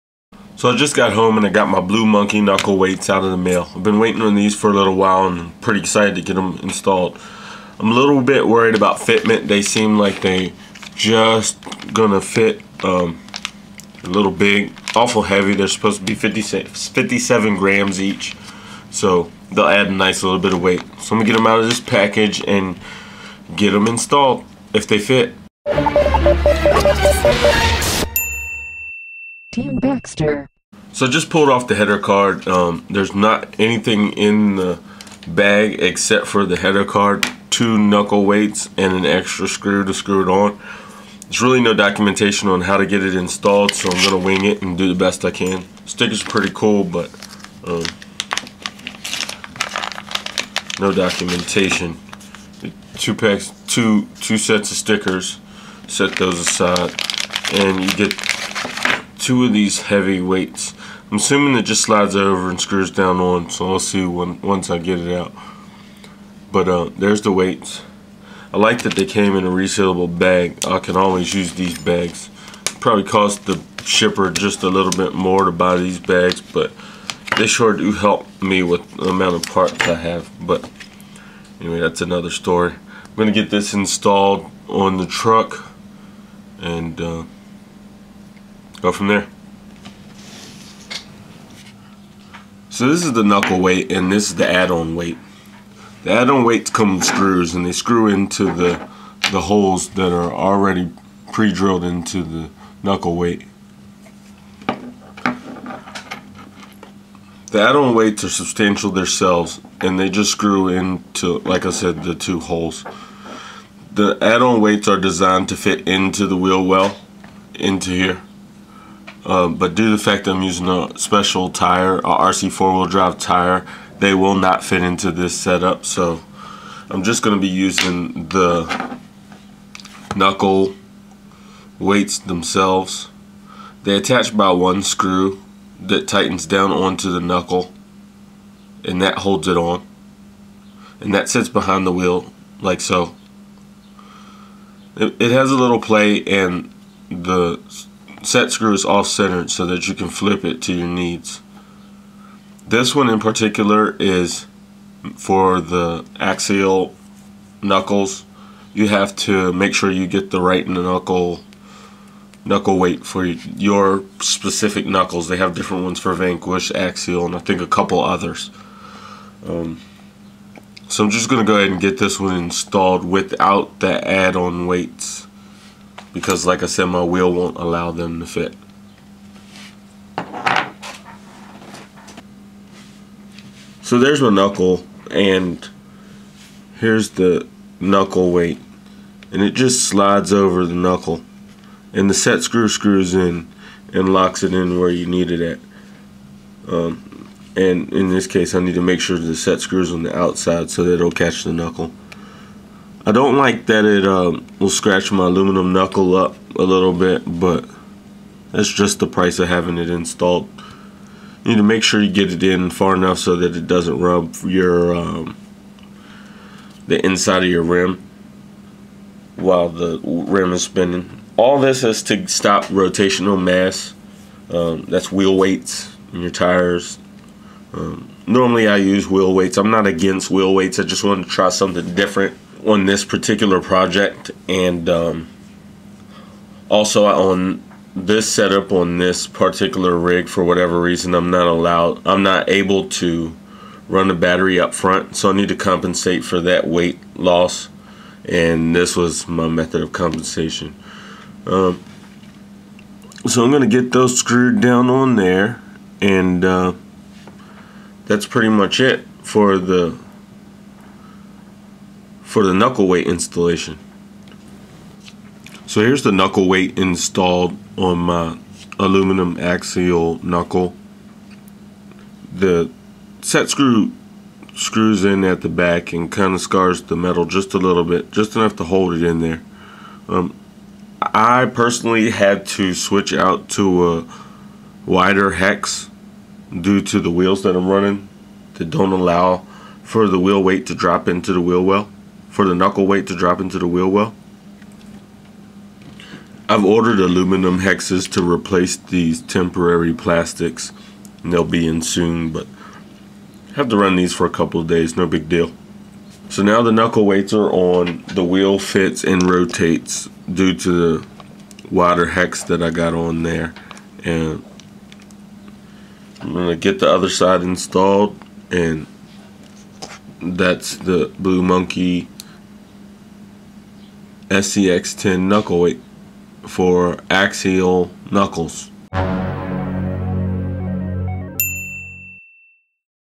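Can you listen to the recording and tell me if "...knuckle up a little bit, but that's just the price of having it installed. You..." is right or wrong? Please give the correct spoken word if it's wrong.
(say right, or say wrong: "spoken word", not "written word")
right.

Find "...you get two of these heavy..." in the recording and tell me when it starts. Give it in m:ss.
0:57.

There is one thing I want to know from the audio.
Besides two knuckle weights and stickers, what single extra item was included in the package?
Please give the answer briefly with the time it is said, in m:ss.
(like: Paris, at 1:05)
an extra screw, at 0:38.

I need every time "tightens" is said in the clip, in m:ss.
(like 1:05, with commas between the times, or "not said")
2:16.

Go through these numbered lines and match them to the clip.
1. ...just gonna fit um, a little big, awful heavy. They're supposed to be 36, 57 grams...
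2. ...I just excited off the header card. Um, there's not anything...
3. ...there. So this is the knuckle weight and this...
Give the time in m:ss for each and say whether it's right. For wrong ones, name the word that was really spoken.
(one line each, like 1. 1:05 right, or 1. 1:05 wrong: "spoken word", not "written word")
1. 0:10 wrong: "56", not "36"
2. 0:31 wrong: "pulled", not "excited"
3. 1:29 right.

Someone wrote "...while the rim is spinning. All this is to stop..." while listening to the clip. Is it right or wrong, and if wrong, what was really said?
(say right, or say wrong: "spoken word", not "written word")
right.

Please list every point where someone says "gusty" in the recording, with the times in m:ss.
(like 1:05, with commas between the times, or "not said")
not said.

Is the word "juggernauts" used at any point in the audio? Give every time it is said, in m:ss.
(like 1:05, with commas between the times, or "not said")
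not said.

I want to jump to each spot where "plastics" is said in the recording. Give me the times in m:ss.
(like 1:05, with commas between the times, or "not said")
4:59.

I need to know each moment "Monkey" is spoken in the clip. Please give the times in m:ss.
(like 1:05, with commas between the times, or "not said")
0:02, 5:21.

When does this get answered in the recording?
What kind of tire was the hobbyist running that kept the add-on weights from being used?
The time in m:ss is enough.
2:02.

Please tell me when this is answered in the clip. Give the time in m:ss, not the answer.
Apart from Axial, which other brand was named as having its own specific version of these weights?
2:46.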